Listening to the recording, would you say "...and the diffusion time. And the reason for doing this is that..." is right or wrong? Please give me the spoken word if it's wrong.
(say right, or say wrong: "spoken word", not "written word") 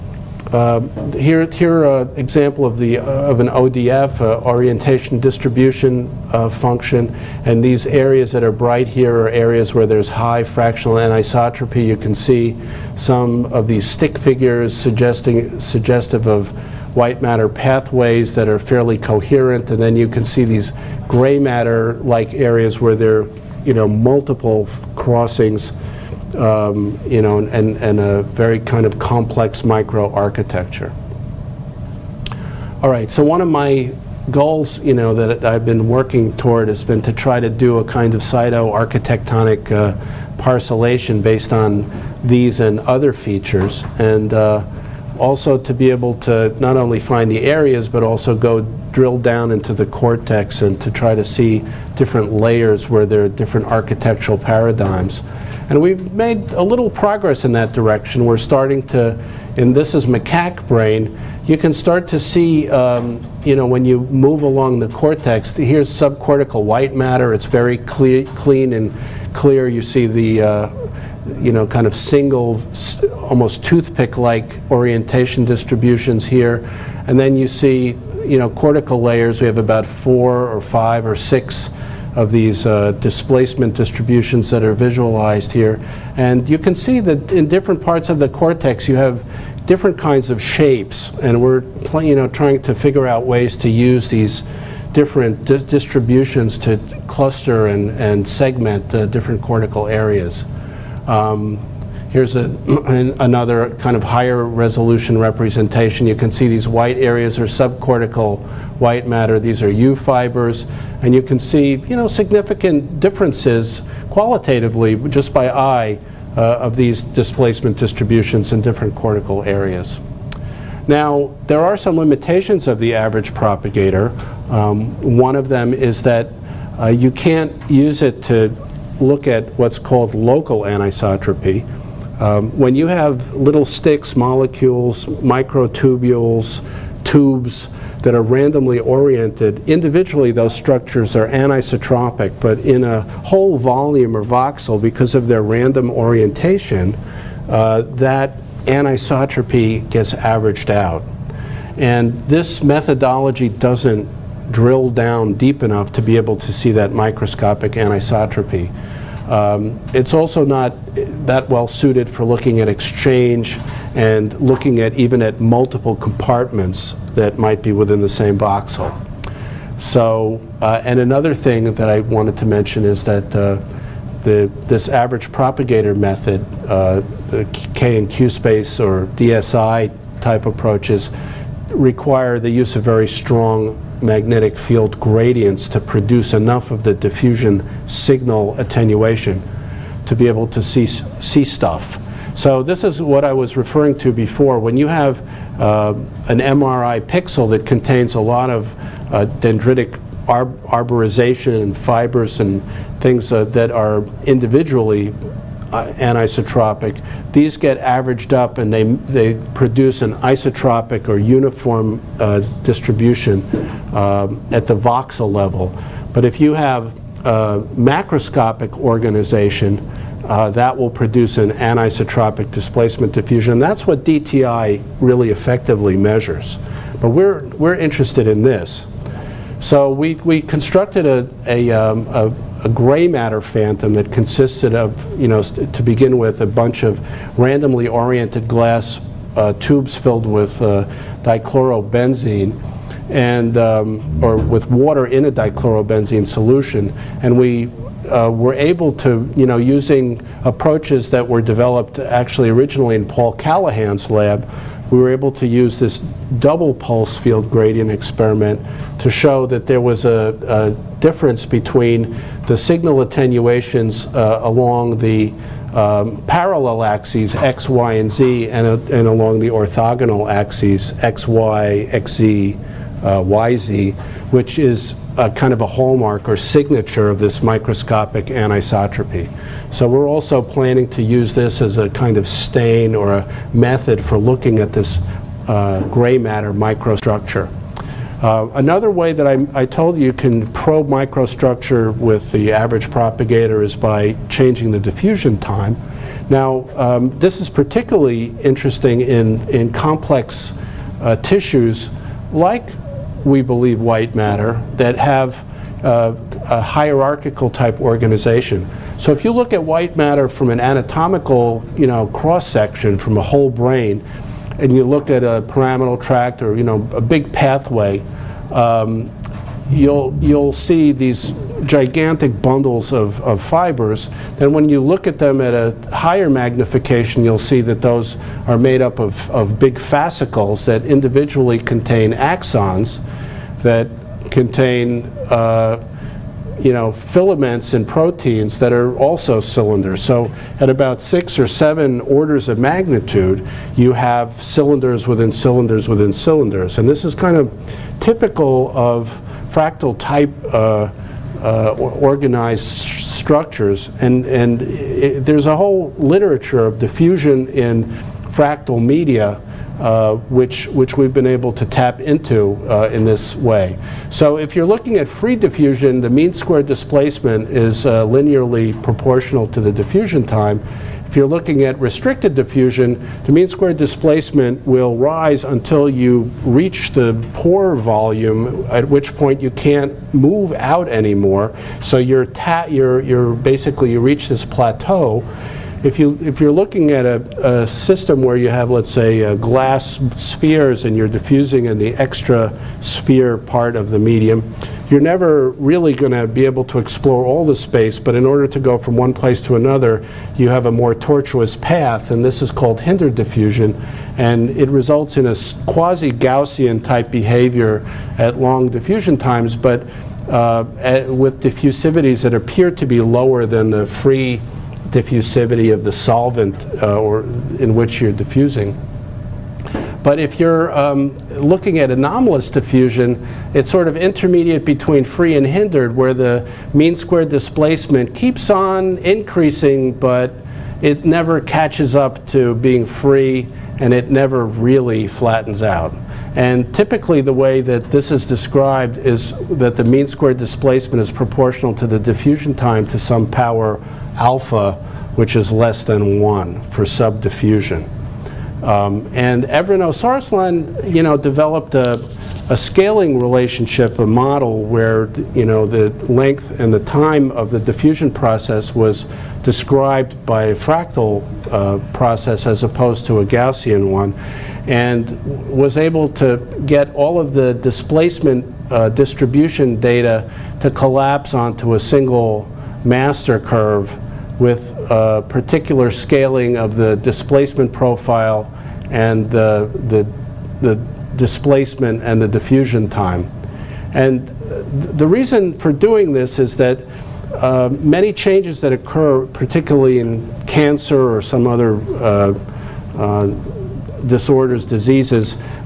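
right.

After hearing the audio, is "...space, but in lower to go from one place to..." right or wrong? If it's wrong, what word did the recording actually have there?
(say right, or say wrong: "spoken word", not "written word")
wrong: "order", not "lower".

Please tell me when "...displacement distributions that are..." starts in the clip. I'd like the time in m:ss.
1:22.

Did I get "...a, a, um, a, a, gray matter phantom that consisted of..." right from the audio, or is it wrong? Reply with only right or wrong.
right.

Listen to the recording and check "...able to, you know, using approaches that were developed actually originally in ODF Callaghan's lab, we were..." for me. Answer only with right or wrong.
wrong.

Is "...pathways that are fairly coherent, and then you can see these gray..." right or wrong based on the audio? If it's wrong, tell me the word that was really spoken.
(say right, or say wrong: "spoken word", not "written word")
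right.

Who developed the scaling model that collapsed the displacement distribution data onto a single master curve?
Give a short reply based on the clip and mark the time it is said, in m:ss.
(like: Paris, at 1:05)
Evren Özarslan, at 7:29.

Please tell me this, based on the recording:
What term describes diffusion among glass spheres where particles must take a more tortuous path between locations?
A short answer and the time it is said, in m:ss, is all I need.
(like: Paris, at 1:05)
Hindered diffusion, at 6:42.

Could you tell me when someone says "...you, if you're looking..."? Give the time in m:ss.
6:25.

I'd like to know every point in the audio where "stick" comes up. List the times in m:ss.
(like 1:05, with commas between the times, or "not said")
0:13, 2:13.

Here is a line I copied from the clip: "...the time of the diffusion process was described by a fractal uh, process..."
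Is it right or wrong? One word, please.
right.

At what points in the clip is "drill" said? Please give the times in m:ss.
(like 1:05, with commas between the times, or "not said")
0:48, 2:34.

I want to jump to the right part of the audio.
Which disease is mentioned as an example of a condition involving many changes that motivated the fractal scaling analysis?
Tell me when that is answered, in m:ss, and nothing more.
8:10.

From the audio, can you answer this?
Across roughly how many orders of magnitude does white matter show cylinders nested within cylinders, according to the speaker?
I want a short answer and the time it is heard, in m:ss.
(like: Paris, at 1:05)
6 or 7, at 5:41.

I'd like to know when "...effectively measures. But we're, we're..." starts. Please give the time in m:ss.
3:45.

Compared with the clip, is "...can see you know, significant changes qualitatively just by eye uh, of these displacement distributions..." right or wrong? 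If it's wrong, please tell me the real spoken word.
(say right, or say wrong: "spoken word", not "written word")
wrong: "differences", not "changes".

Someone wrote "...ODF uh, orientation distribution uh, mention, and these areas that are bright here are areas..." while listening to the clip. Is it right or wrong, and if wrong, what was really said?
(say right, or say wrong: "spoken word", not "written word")
wrong: "function", not "mention".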